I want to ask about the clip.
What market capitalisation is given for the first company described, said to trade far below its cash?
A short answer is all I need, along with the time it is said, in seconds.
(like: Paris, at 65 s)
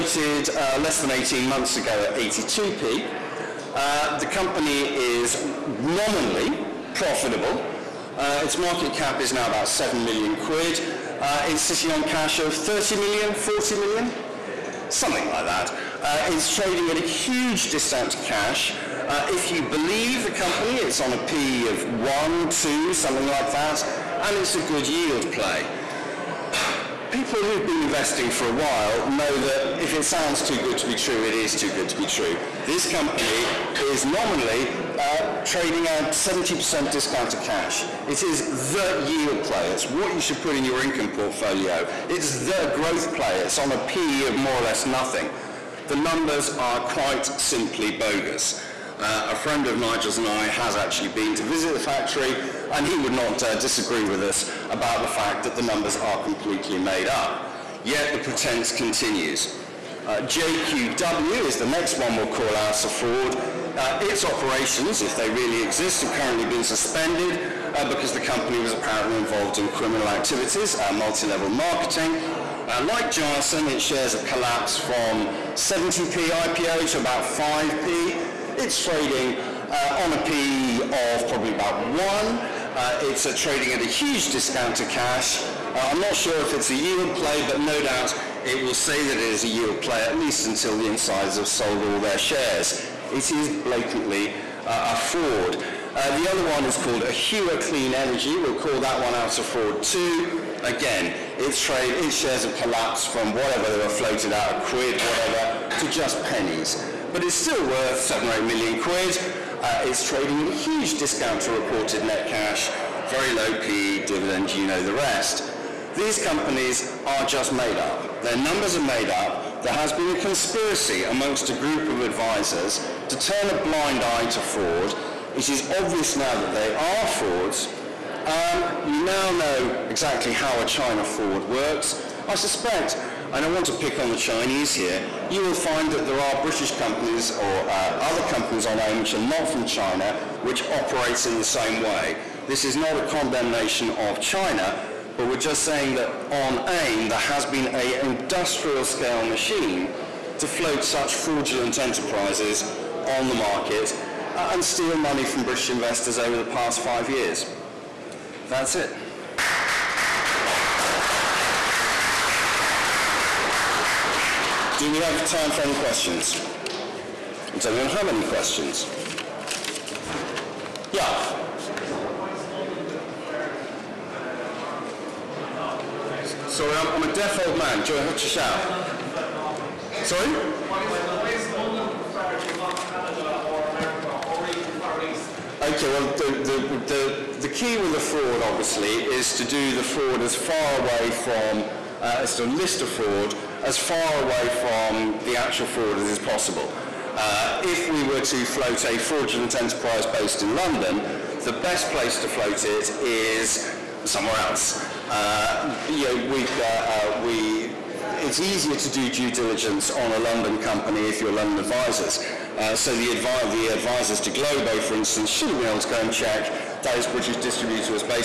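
about £7 million, at 9 s.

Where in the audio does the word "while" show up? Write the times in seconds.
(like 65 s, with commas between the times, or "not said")
28 s.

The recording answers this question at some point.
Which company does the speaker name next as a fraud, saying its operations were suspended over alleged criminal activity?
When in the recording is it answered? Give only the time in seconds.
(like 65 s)
60 s.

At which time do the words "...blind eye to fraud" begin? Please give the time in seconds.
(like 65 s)
123 s.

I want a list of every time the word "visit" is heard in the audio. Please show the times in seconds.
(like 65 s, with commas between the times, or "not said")
51 s.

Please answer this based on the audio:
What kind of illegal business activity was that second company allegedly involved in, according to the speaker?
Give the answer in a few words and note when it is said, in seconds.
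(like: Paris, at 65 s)
multi-level marketing, at 70 s.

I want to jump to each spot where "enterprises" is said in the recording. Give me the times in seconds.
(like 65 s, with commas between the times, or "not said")
151 s, 199 s.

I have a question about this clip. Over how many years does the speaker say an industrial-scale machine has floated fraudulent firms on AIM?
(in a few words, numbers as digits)
5 years.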